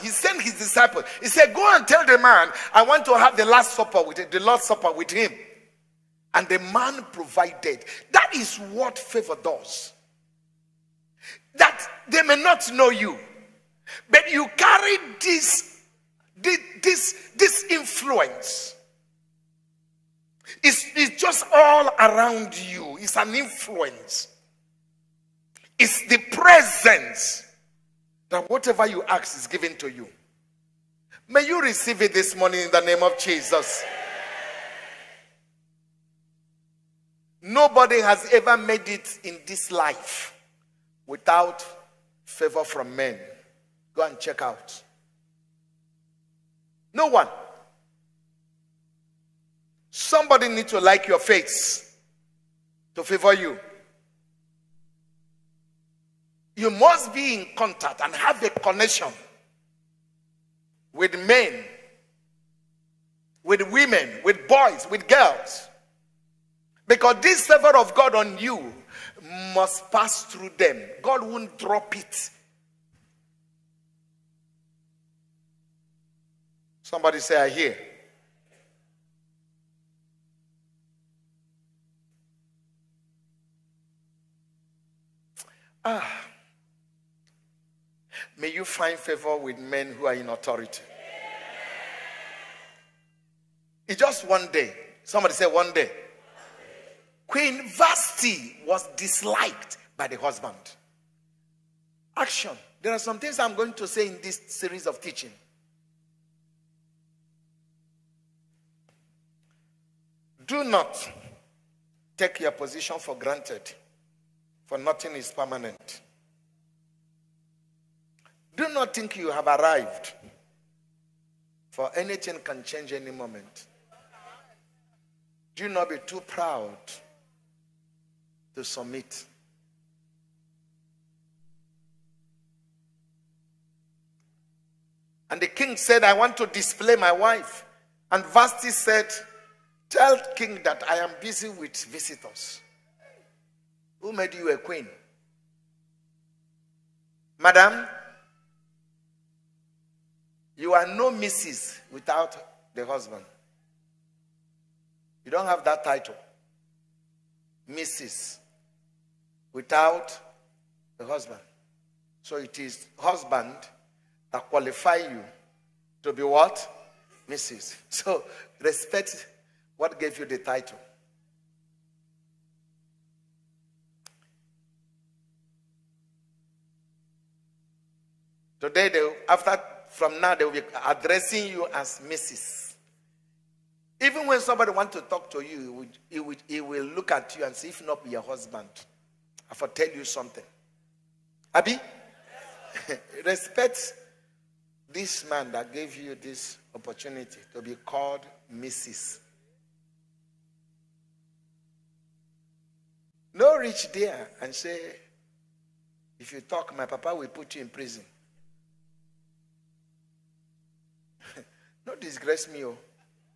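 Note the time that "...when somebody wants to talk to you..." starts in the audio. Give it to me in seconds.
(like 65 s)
184 s.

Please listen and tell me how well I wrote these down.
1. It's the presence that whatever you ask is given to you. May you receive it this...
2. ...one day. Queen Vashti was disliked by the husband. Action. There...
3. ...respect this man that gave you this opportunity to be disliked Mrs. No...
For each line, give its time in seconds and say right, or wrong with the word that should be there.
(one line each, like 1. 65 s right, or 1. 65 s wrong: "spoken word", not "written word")
1. 25 s right
2. 95 s right
3. 193 s wrong: "called", not "disliked".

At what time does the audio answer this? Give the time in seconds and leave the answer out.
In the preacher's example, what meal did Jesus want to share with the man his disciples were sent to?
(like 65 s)
3 s.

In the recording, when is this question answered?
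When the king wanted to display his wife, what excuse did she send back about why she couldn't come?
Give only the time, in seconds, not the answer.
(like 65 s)
141 s.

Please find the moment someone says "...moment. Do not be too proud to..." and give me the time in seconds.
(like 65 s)
123 s.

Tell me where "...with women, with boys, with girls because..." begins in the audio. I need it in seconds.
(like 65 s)
63 s.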